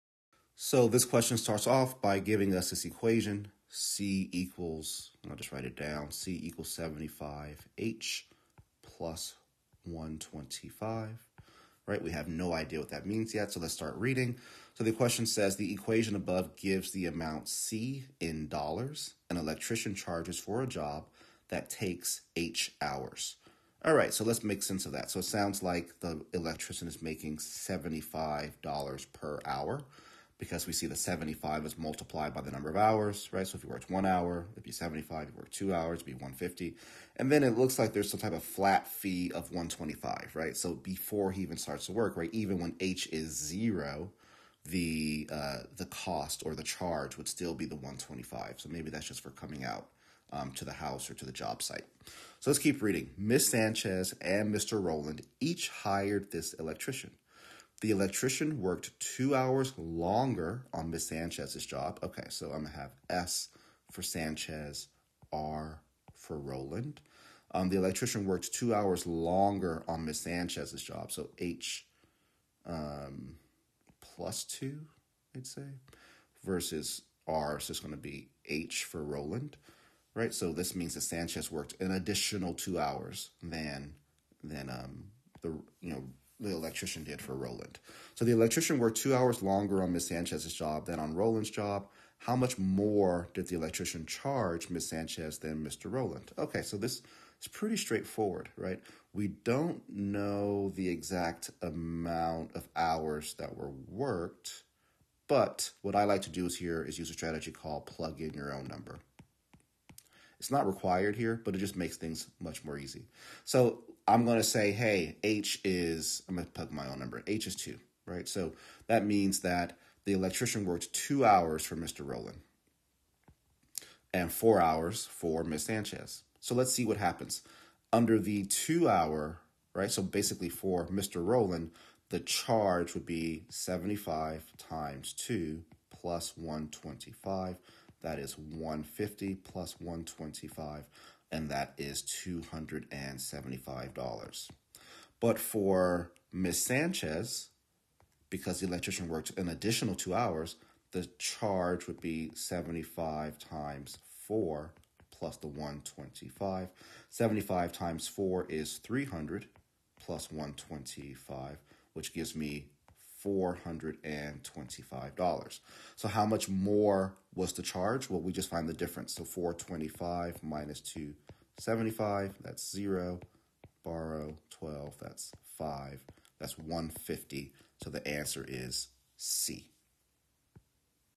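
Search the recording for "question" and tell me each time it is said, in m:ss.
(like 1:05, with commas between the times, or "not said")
0:01, 0:14.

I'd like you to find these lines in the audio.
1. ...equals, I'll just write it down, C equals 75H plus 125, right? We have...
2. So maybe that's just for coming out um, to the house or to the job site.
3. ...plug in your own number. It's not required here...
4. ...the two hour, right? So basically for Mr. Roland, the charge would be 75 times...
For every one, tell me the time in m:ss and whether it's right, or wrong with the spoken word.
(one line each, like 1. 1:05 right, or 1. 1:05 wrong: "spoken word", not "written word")
1. 0:04 right
2. 0:48 right
3. 1:47 right
4. 2:08 right.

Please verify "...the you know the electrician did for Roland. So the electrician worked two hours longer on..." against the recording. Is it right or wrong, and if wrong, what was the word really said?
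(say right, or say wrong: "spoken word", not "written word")
right.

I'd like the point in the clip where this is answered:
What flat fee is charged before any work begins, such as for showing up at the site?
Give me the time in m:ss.
0:38.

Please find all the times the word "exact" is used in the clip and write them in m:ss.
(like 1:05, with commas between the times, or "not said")
1:40.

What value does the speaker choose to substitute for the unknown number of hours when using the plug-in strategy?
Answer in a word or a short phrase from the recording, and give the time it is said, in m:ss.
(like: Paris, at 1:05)
2, at 1:57.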